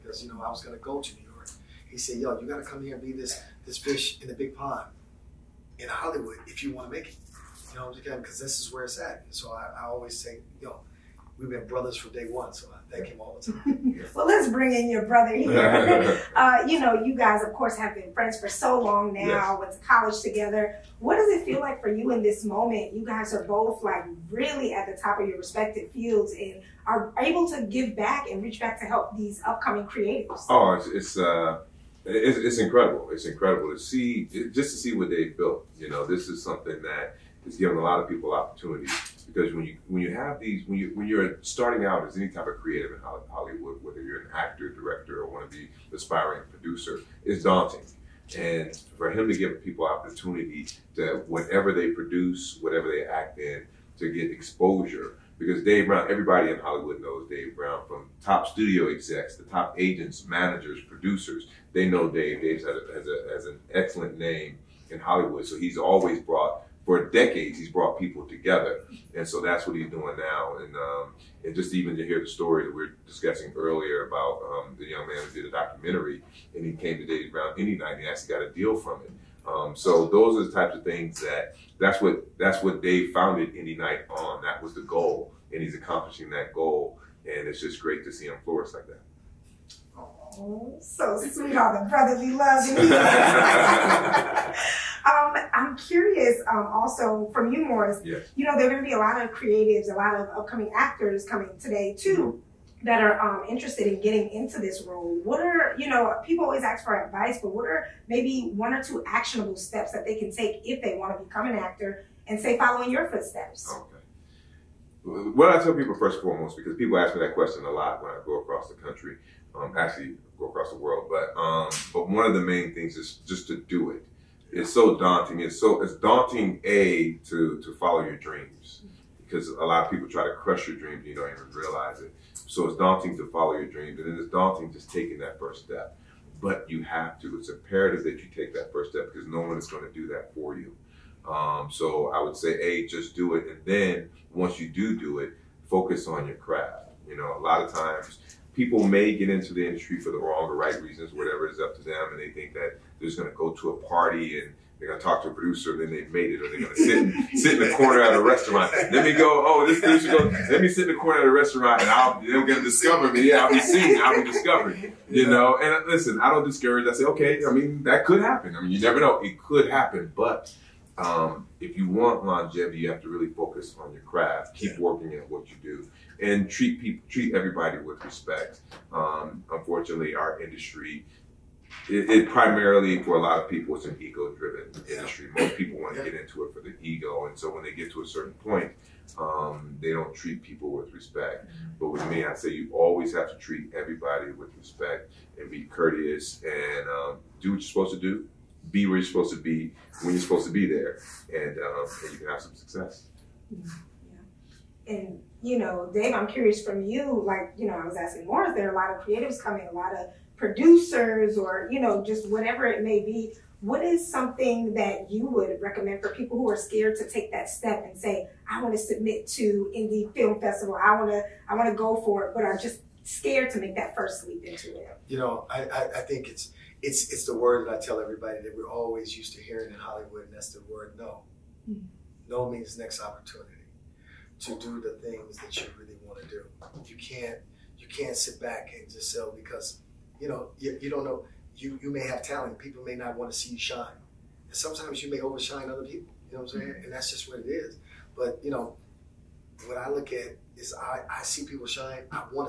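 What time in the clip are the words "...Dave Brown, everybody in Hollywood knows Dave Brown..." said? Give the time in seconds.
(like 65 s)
55 s.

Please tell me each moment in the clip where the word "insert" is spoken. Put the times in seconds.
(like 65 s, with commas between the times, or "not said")
not said.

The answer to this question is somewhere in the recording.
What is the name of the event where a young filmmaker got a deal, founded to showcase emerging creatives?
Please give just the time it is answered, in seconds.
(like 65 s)
77 s.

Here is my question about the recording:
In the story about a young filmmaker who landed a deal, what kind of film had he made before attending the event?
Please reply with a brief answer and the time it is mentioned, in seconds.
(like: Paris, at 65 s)
Documentary, at 75 s.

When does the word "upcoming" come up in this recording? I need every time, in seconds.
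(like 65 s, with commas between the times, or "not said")
29 s, 100 s.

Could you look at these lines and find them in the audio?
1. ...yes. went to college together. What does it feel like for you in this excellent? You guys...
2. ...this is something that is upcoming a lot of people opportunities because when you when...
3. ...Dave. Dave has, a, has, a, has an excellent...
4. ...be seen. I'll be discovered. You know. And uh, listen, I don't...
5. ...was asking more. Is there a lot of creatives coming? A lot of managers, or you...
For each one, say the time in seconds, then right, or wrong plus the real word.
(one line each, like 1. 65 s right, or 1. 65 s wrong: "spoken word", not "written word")
1. 19 s wrong: "moment", not "excellent"
2. 36 s wrong: "giving", not "upcoming"
3. 62 s right
4. 163 s right
5. 207 s wrong: "producers", not "managers".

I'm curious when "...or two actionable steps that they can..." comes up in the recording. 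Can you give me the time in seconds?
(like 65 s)
108 s.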